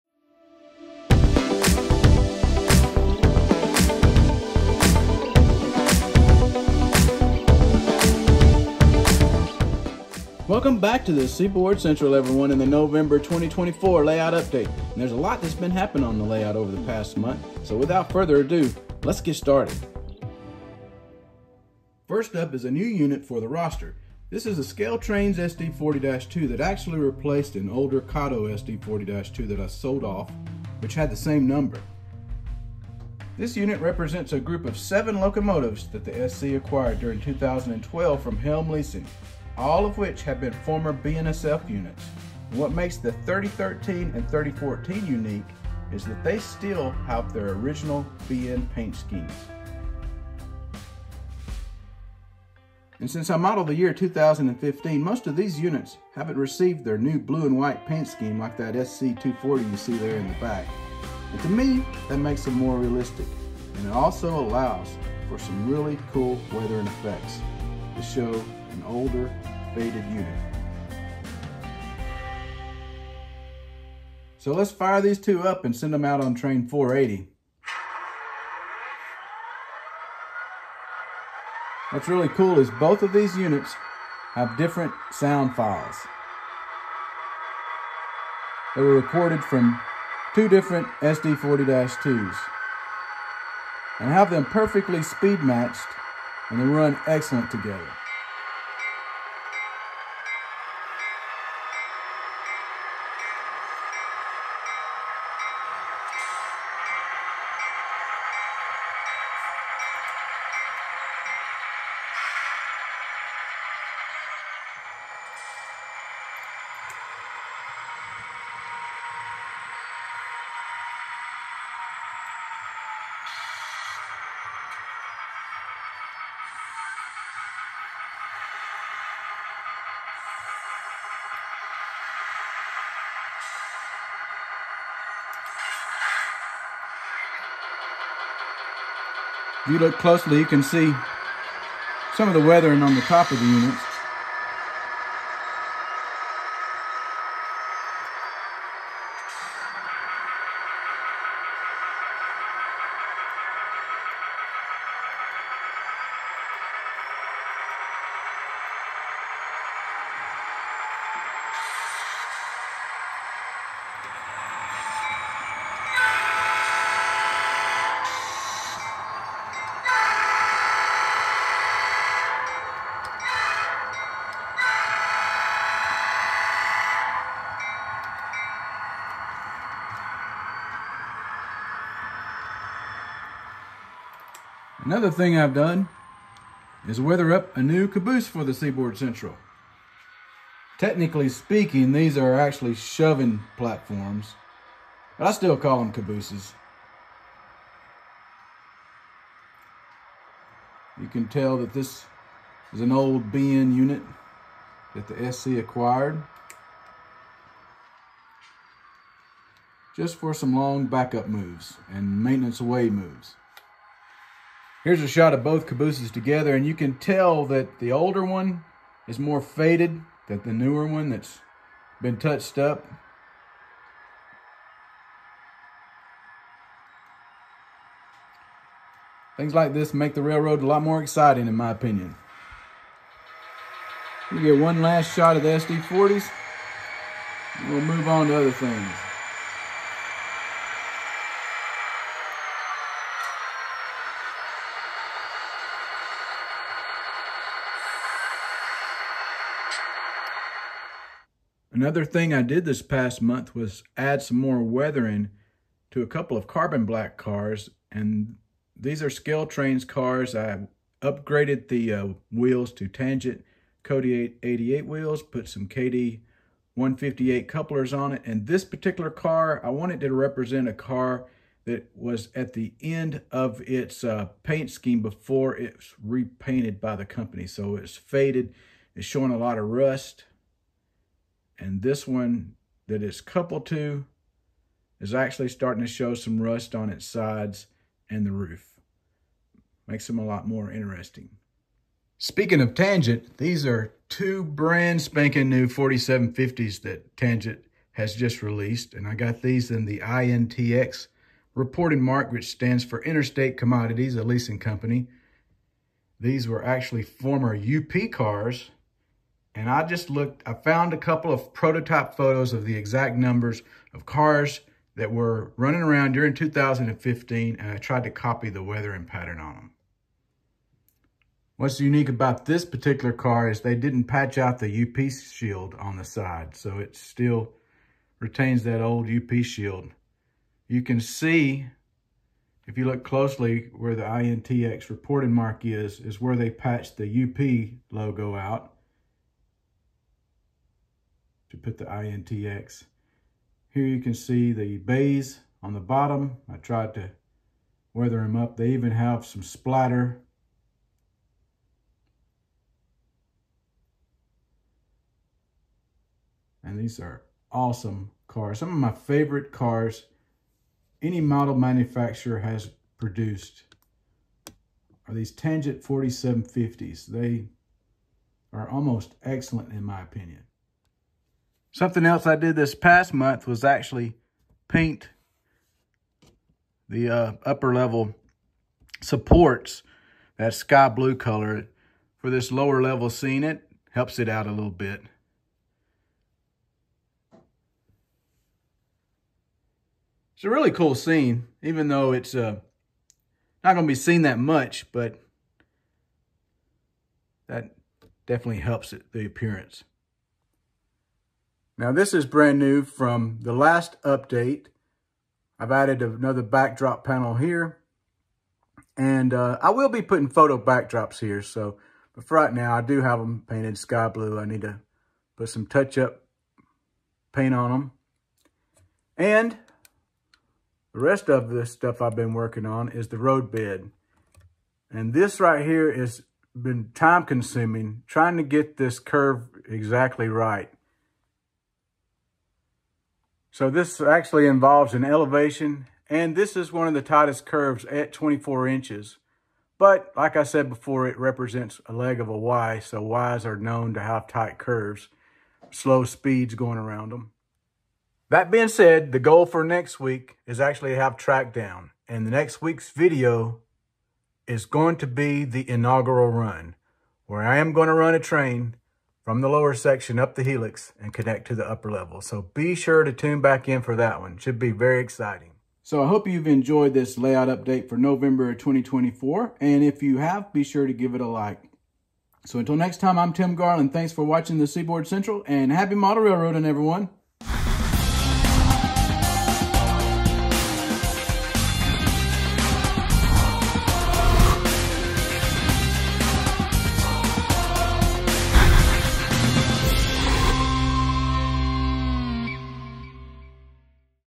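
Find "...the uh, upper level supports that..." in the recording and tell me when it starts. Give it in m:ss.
6:16.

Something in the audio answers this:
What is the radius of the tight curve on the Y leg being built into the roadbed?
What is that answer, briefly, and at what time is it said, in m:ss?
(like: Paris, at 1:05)
24 inches, at 7:18.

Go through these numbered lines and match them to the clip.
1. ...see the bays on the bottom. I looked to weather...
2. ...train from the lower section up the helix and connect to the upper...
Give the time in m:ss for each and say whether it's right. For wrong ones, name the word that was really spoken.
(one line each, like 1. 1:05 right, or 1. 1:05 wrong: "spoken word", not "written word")
1. 5:44 wrong: "tried", not "looked"
2. 7:38 right.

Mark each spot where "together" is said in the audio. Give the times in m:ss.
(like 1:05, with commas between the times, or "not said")
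1:37, 3:36.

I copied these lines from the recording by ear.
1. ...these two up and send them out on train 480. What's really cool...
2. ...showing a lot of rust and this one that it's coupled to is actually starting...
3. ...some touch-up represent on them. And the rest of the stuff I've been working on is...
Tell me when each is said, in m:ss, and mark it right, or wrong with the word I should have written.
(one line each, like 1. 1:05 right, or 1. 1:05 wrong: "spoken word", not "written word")
1. 1:15 right
2. 4:39 right
3. 6:55 wrong: "paint", not "represent".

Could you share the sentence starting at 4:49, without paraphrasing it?
Makes them a lot more interesting.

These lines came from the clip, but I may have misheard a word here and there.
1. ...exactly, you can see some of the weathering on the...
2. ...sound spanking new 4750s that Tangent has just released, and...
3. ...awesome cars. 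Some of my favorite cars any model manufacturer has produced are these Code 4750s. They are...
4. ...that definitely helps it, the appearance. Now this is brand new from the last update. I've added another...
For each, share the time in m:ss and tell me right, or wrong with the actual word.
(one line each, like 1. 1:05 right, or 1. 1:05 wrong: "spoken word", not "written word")
1. 2:19 wrong: "closely", not "exactly"
2. 4:54 wrong: "brand", not "sound"
3. 5:57 wrong: "Tangent", not "Code"
4. 6:37 right.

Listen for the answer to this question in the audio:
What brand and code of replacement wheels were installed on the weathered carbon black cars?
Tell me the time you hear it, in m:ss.
4:22.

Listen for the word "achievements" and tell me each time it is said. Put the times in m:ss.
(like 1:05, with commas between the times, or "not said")
not said.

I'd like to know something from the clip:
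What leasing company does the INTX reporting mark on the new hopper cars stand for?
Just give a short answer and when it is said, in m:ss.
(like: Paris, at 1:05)
Interstate Commodities, at 5:03.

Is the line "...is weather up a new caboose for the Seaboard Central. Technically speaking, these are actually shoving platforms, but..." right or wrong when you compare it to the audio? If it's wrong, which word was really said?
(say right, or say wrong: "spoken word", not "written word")
right.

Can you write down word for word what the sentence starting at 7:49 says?
And if you have, be sure to give it a like.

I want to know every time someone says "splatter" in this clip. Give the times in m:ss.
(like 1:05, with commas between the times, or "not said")
5:49.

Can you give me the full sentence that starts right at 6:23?
It helps it out a little bit.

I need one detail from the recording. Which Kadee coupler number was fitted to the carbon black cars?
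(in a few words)
158.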